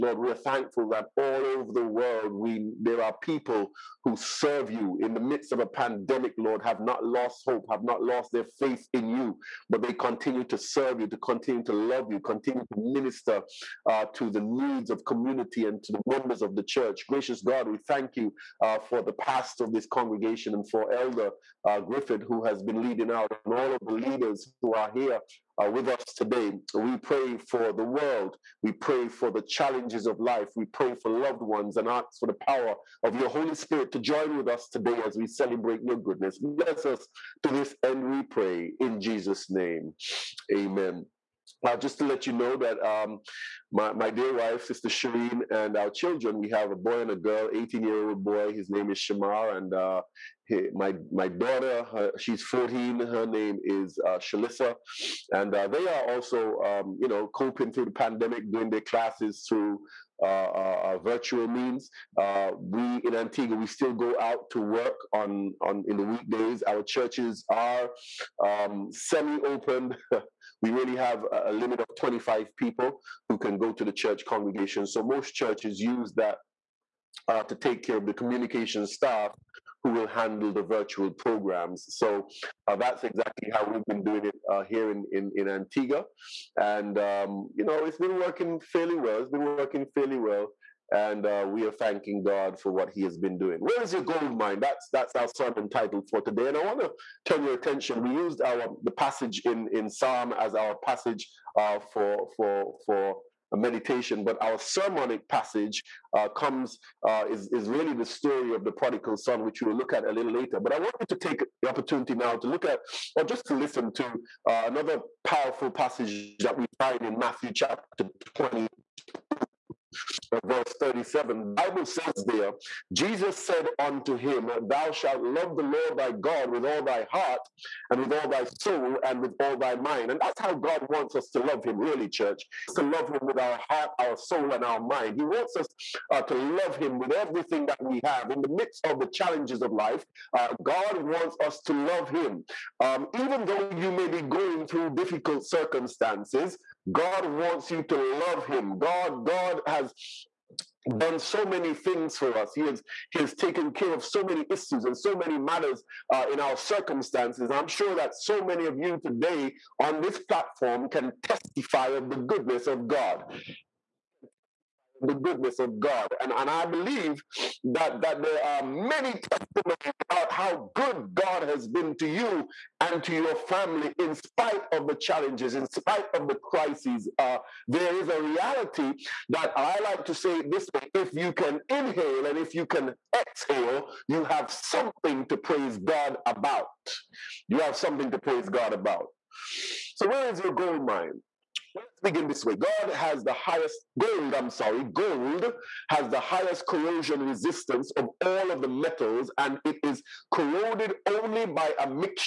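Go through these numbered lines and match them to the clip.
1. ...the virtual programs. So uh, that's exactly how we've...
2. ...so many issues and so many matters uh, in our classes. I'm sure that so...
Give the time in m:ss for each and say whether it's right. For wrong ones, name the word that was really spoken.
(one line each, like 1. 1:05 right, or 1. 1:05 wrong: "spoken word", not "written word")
1. 1:20 right
2. 2:34 wrong: "circumstances", not "classes".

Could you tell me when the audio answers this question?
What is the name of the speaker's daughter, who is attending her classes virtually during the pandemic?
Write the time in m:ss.
0:54.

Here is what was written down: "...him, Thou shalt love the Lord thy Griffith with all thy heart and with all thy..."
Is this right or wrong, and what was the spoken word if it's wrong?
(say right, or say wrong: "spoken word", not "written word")
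wrong: "God", not "Griffith".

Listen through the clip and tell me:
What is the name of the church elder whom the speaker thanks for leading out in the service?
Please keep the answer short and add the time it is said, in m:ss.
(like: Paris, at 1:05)
Griffith, at 0:21.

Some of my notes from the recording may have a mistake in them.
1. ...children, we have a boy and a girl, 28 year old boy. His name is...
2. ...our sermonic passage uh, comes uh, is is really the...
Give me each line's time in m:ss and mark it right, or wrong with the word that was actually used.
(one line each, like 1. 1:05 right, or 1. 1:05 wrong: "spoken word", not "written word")
1. 0:45 wrong: "18", not "28"
2. 1:44 right.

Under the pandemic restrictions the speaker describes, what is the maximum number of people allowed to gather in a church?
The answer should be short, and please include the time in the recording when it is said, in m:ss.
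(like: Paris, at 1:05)
25, at 1:11.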